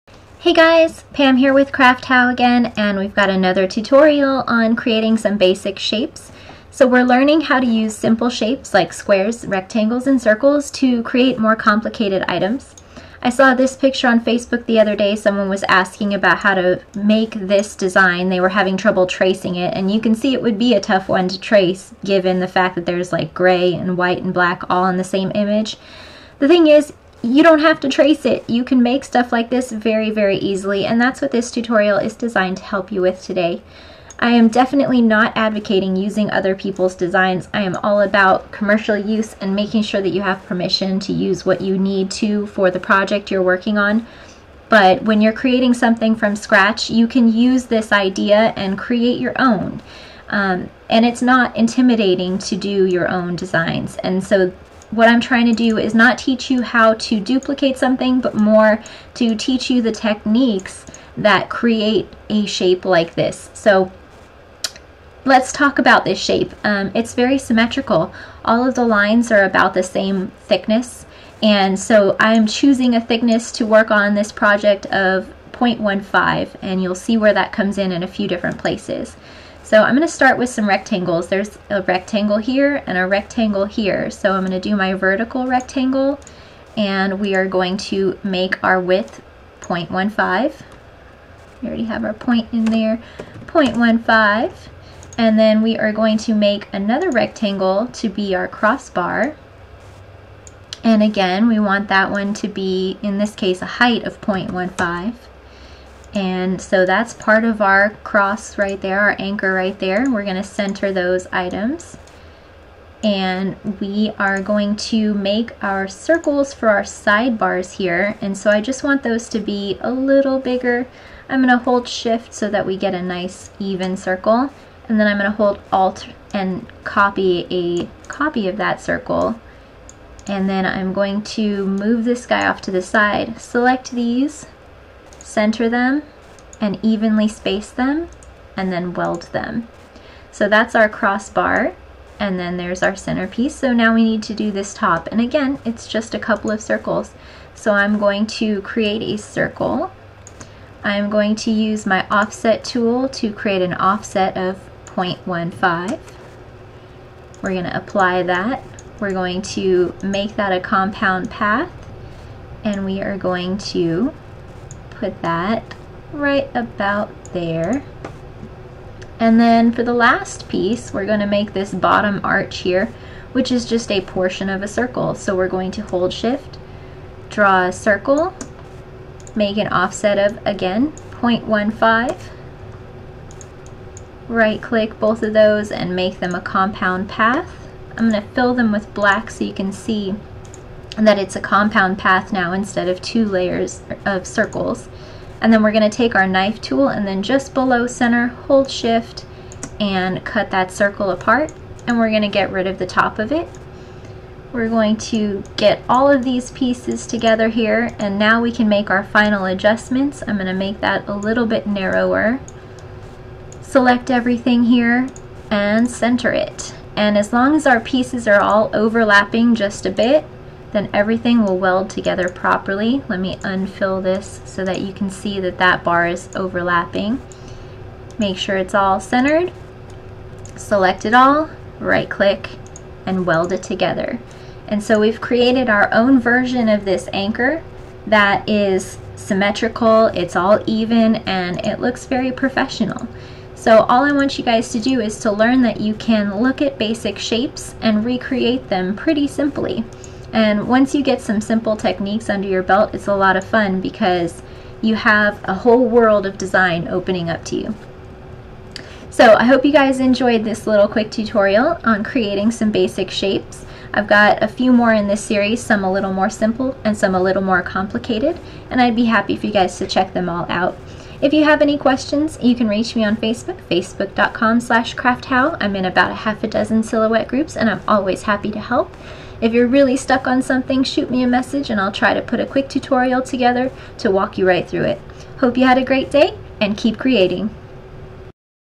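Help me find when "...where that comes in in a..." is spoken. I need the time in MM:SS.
01:17.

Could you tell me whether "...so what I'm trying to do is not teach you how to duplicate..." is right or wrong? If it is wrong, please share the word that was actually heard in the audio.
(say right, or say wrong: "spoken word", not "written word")
right.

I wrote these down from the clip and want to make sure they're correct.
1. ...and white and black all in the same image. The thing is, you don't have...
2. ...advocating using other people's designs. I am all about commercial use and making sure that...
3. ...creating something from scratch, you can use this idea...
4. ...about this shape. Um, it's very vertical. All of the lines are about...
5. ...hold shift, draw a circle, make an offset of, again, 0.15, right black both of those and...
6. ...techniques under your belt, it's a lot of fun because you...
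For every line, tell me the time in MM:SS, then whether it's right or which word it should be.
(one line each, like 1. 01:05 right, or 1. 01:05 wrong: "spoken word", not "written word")
1. 00:23 right
2. 00:35 right
3. 00:45 right
4. 01:05 wrong: "symmetrical", not "vertical"
5. 02:55 wrong: "click", not "black"
6. 04:11 right.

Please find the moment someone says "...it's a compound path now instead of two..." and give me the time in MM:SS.
03:11.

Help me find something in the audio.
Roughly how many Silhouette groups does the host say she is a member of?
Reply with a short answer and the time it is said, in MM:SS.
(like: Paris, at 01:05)
half a dozen, at 04:36.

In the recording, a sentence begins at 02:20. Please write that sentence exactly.
So that's our crossbar, and then there's our centerpiece.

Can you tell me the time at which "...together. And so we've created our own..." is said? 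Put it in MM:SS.
03:53.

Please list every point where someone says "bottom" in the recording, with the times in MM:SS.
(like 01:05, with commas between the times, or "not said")
02:51.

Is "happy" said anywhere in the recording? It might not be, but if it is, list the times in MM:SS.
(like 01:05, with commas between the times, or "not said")
04:29, 04:38.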